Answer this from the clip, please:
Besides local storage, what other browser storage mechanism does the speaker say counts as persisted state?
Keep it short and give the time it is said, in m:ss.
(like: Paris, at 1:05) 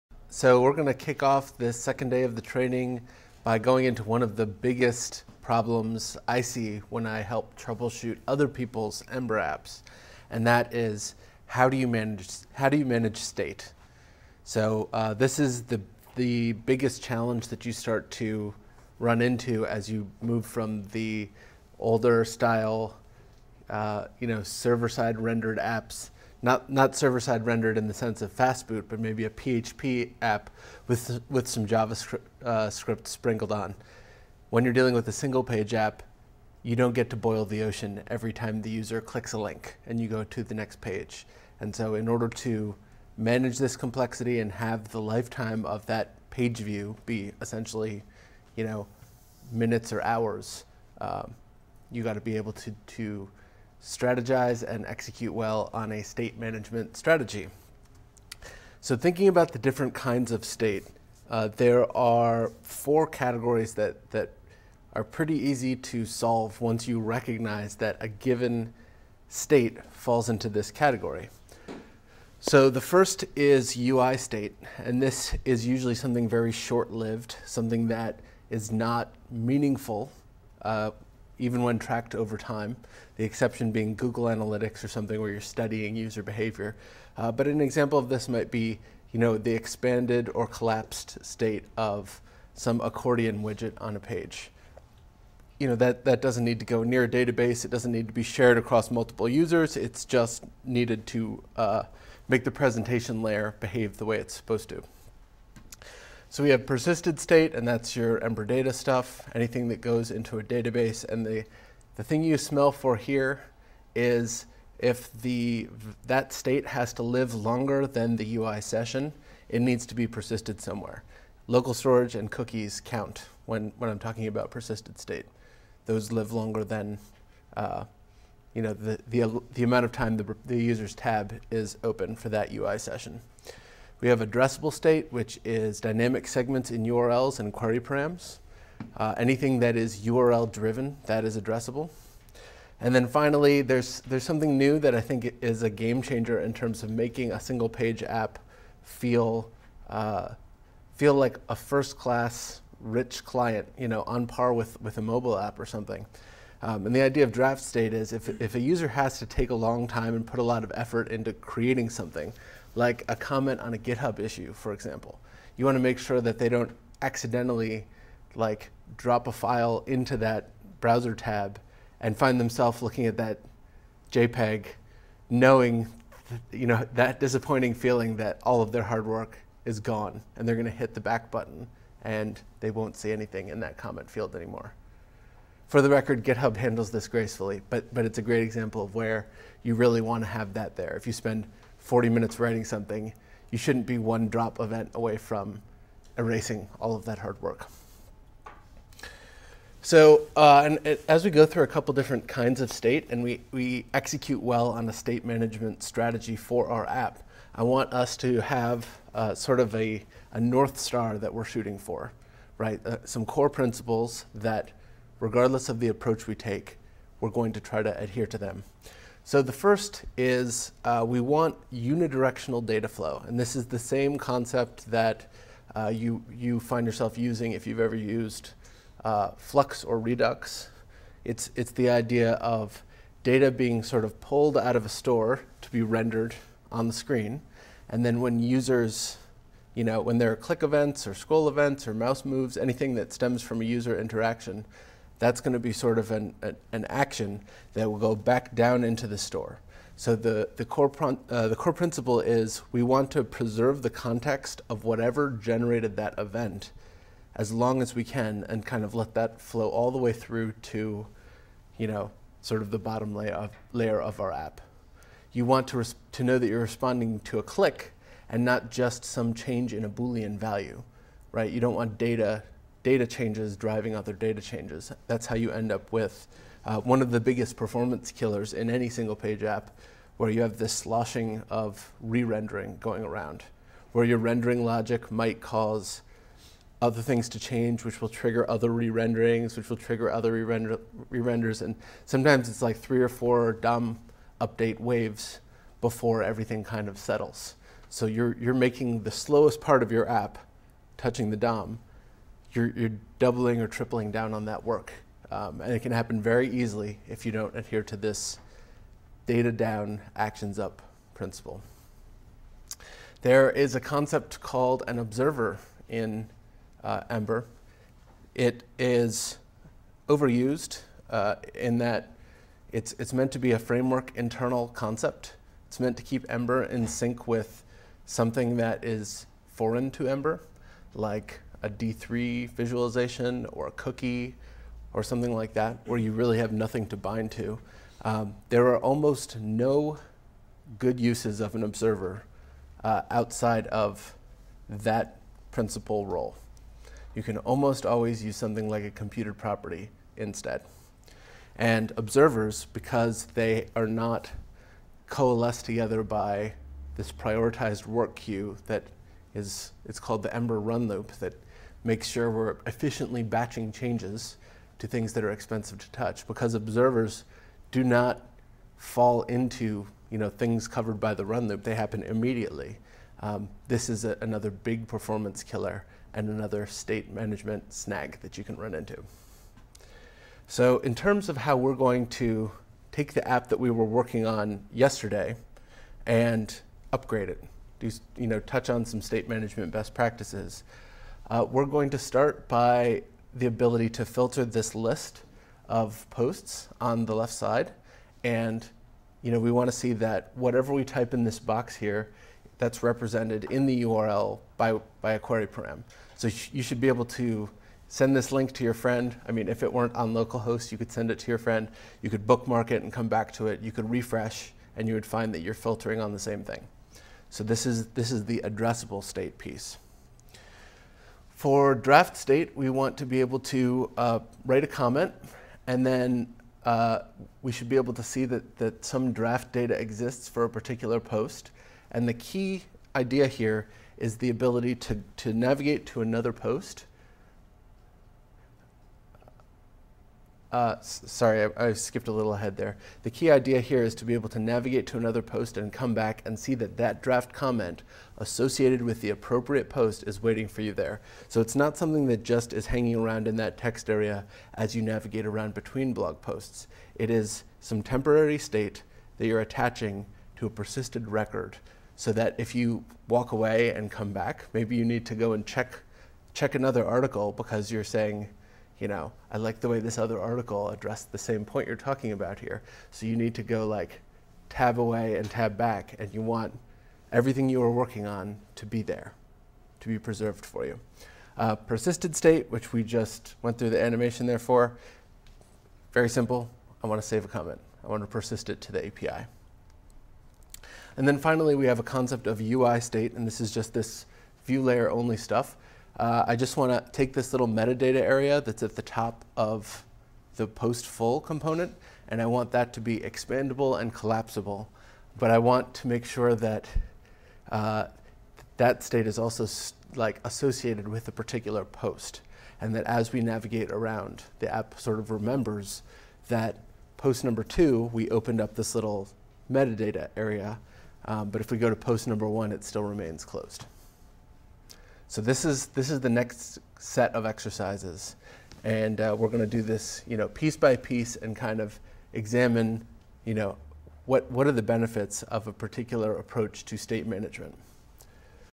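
cookies, at 2:02.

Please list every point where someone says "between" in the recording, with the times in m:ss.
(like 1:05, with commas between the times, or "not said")
7:35.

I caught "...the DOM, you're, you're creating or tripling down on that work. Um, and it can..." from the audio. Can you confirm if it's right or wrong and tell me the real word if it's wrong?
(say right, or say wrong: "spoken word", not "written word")
wrong: "doubling", not "creating".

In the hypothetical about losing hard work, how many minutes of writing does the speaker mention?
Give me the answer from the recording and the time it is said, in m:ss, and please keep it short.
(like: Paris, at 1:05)
40, at 3:11.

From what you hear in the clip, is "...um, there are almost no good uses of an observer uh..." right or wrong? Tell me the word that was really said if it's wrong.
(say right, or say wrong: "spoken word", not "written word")
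right.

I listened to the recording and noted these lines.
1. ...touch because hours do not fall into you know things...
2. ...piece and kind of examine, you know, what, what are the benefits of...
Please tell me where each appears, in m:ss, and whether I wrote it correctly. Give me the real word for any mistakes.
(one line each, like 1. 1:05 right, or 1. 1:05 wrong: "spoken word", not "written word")
1. 6:05 wrong: "observers", not "hours"
2. 8:50 right.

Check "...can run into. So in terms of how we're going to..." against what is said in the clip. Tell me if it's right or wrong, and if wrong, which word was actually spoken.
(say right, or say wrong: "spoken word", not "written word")
right.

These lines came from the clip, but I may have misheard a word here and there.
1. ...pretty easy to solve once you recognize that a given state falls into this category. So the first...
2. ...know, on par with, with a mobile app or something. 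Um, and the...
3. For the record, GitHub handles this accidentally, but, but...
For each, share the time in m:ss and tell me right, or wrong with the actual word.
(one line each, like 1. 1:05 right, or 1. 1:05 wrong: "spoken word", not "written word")
1. 1:05 right
2. 2:33 right
3. 3:05 wrong: "gracefully", not "accidentally".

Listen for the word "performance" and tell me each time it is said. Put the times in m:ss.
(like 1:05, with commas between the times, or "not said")
4:37, 6:14.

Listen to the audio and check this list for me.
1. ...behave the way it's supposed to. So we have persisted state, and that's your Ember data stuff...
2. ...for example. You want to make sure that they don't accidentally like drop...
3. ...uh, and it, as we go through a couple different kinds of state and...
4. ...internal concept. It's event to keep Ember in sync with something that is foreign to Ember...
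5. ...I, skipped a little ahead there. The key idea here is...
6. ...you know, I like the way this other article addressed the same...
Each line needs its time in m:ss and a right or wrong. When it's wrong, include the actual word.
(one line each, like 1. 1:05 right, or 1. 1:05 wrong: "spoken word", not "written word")
1. 1:43 right
2. 2:44 right
3. 3:20 right
4. 5:24 wrong: "meant", not "event"
5. 7:21 right
6. 7:48 right.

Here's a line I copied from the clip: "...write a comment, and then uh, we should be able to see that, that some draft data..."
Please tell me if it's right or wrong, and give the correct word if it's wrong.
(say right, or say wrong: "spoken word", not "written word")
right.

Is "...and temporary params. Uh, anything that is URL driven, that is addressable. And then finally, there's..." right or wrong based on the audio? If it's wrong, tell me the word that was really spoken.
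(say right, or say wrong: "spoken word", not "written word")
wrong: "query", not "temporary".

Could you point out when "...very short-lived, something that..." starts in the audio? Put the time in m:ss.
1:16.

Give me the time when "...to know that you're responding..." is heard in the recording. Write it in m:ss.
4:26.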